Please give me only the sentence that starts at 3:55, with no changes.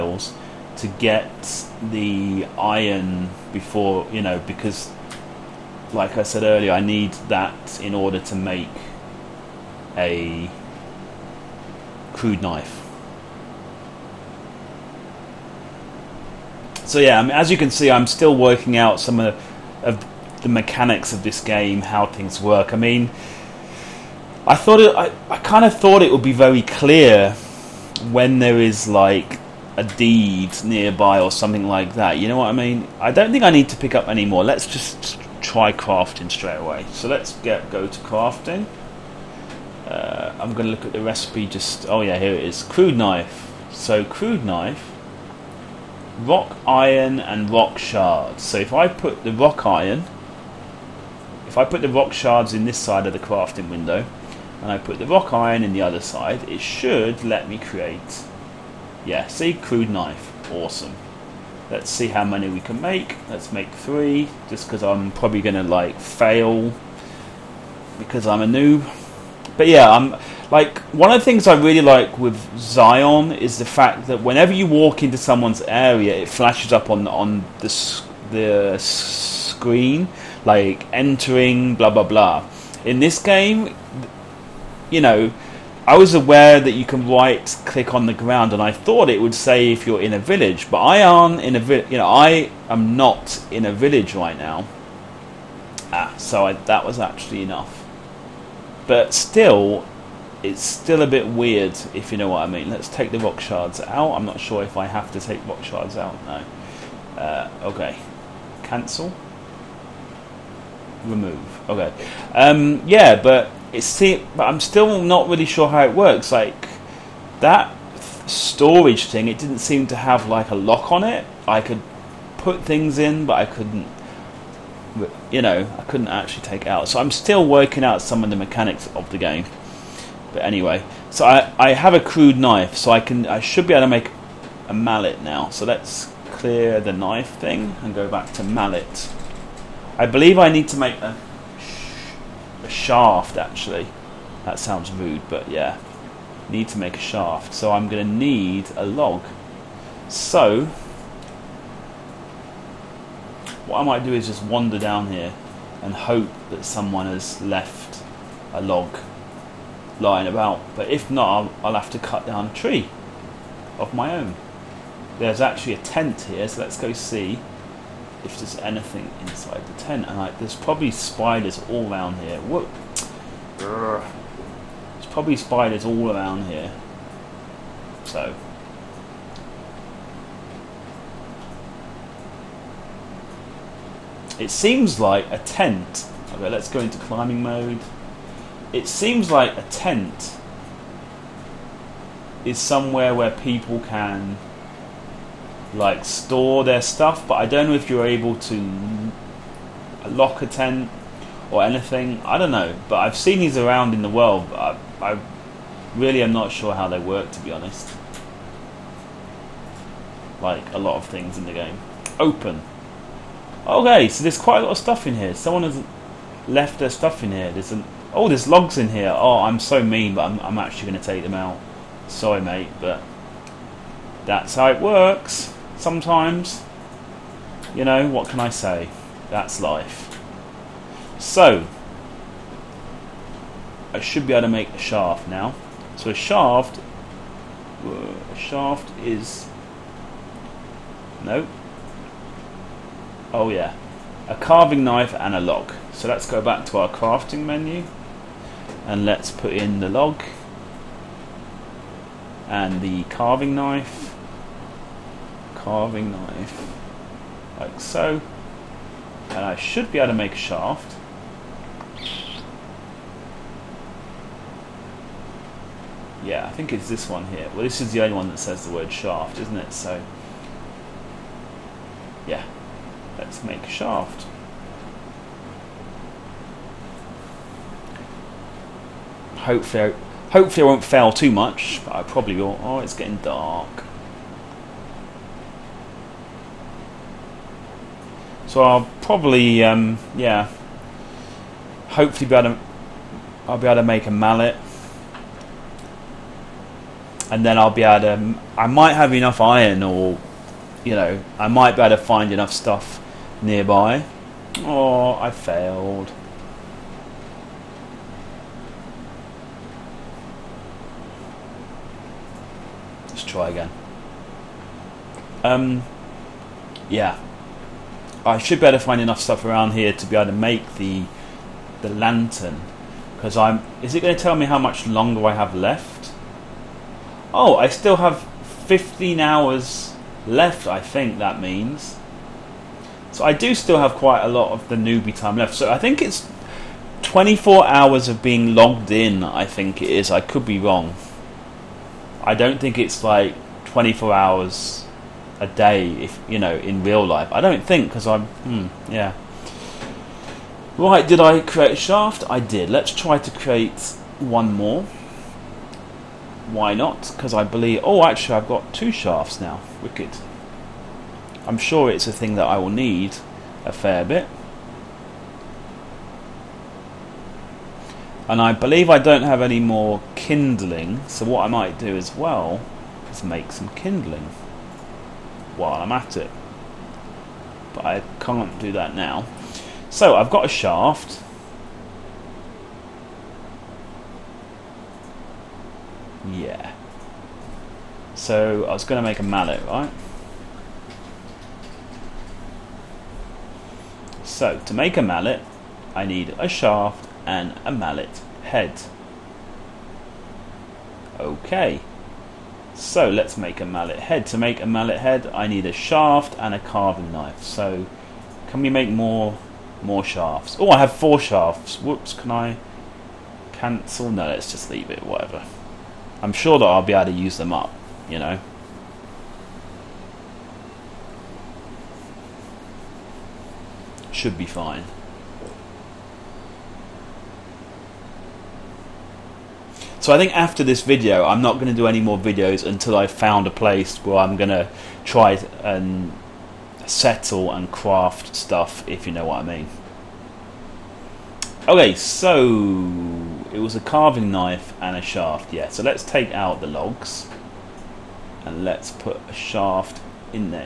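So a shaft, uh, a shaft is, no, Oh yeah, a carving knife and a log.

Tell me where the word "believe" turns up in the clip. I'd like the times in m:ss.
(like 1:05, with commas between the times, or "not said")
2:20, 5:57, 6:08.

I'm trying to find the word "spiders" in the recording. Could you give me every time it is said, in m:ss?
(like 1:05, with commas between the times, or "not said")
2:50, 2:55.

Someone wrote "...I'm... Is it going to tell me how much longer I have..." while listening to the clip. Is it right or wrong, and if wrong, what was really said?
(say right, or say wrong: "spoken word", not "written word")
right.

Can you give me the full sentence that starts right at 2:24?
That sounds rude, but yeah, need to make a shaft.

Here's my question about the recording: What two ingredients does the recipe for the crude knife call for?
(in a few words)
Rock iron and rock shards.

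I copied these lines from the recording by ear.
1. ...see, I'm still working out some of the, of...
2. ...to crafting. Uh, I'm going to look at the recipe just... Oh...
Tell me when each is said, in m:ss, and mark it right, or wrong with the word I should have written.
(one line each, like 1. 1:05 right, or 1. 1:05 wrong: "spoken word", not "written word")
1. 0:17 right
2. 0:37 right.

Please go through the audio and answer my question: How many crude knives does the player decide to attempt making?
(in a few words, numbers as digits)
3.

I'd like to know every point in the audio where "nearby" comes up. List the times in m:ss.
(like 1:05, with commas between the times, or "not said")
0:30, 5:03.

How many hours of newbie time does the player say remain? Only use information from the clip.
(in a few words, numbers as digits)
15.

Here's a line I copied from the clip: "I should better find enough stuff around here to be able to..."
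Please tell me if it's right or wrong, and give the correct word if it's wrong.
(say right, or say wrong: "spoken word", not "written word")
right.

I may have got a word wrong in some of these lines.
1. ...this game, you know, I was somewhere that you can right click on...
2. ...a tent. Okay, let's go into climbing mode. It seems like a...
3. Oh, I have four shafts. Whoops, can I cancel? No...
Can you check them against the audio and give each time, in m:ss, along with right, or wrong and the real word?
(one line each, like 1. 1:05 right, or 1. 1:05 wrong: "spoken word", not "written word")
1. 1:22 wrong: "aware", not "somewhere"
2. 3:05 right
3. 6:50 right.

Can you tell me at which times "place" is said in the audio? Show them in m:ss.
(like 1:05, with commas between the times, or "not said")
7:13.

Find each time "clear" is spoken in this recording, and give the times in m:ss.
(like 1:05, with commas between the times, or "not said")
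0:26, 2:16.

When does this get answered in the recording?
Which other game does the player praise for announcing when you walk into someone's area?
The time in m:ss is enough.
1:12.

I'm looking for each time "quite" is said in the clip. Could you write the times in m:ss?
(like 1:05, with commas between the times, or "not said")
3:34, 5:33.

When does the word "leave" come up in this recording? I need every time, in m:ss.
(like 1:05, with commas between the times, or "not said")
6:54.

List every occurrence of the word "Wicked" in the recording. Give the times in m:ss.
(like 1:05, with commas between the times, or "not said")
5:59.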